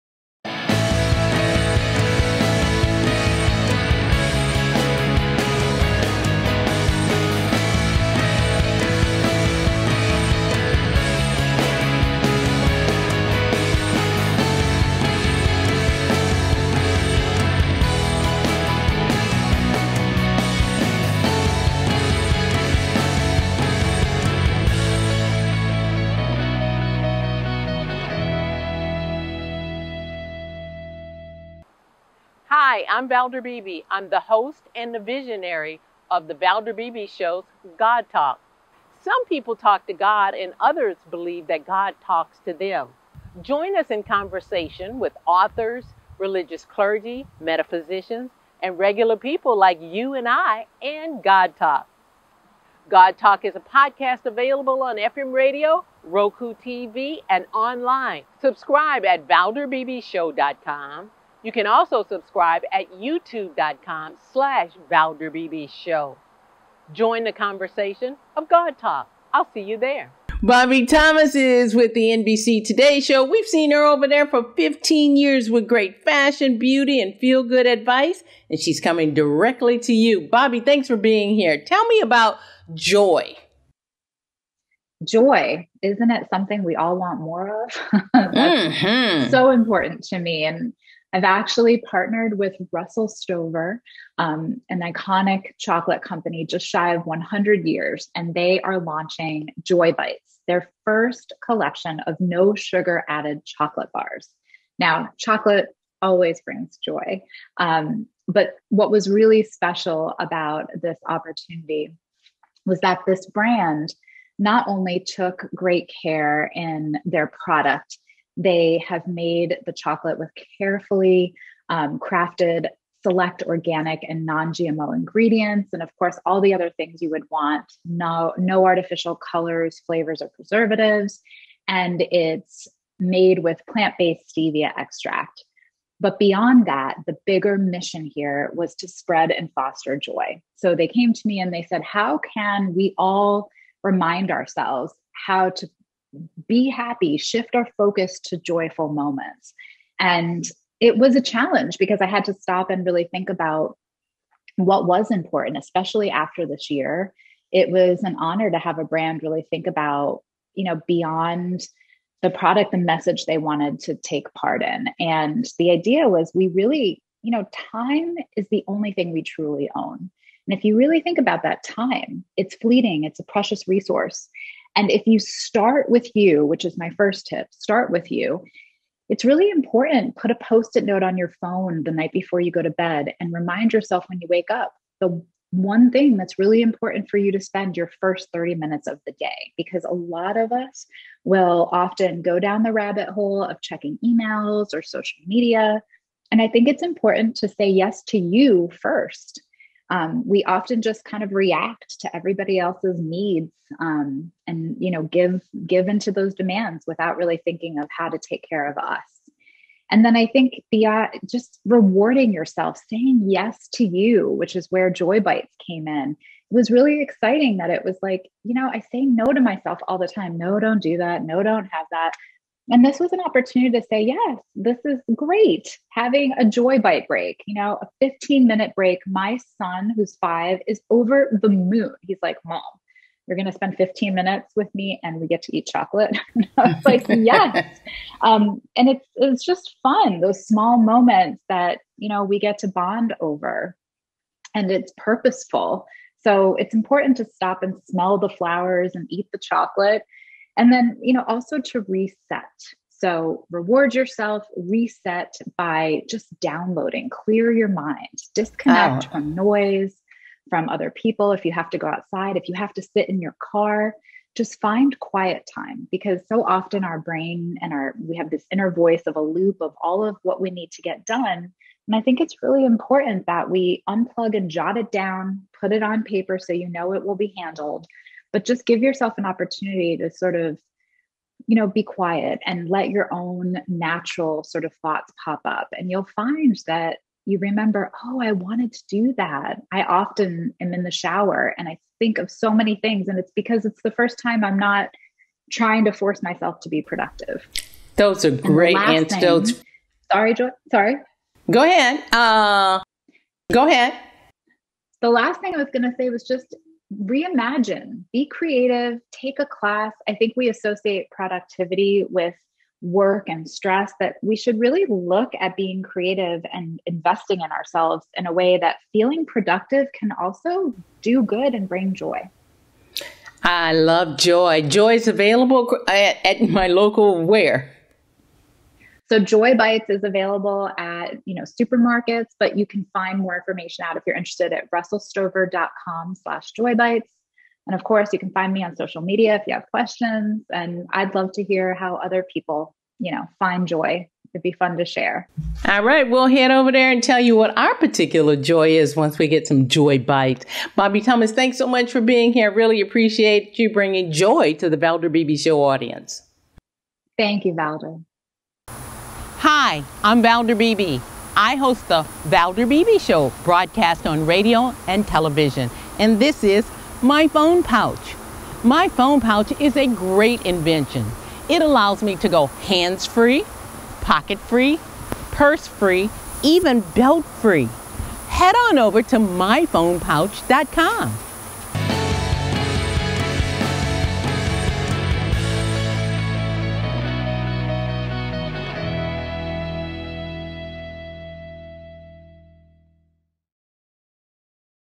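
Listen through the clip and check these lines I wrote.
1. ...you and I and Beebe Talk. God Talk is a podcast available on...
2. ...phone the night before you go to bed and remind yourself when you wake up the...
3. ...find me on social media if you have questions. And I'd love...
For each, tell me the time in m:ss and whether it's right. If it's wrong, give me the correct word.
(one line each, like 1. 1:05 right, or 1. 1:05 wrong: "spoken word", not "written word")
1. 0:49 wrong: "God", not "Beebe"
2. 3:01 right
3. 5:38 right.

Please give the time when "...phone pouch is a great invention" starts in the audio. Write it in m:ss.
6:08.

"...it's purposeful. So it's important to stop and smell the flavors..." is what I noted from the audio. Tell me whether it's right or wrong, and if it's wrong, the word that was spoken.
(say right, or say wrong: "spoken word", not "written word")
wrong: "flowers", not "flavors".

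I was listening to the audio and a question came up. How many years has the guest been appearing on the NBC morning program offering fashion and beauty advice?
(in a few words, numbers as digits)
15.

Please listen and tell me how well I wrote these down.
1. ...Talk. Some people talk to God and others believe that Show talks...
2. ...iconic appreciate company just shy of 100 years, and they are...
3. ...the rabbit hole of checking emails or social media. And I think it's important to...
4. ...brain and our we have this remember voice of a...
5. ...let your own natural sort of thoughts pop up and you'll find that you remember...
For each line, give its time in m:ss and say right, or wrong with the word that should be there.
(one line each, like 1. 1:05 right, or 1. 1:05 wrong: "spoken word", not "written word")
1. 0:38 wrong: "God", not "Show"
2. 1:34 wrong: "chocolate", not "appreciate"
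3. 3:12 right
4. 4:26 wrong: "inner", not "remember"
5. 4:42 right.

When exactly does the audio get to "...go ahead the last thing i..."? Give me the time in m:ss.
5:03.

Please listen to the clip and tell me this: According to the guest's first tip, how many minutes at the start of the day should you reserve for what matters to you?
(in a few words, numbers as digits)
30.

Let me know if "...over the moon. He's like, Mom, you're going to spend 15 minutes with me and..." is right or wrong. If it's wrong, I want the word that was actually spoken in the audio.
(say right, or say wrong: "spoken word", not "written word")
right.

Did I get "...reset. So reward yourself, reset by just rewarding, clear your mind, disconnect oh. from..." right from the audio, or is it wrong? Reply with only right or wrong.
wrong.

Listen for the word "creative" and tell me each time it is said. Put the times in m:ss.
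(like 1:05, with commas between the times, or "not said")
5:08, 5:15.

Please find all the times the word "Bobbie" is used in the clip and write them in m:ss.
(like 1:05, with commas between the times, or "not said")
1:10, 1:20, 5:50.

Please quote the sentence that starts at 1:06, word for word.
Join the conversation of God Talk.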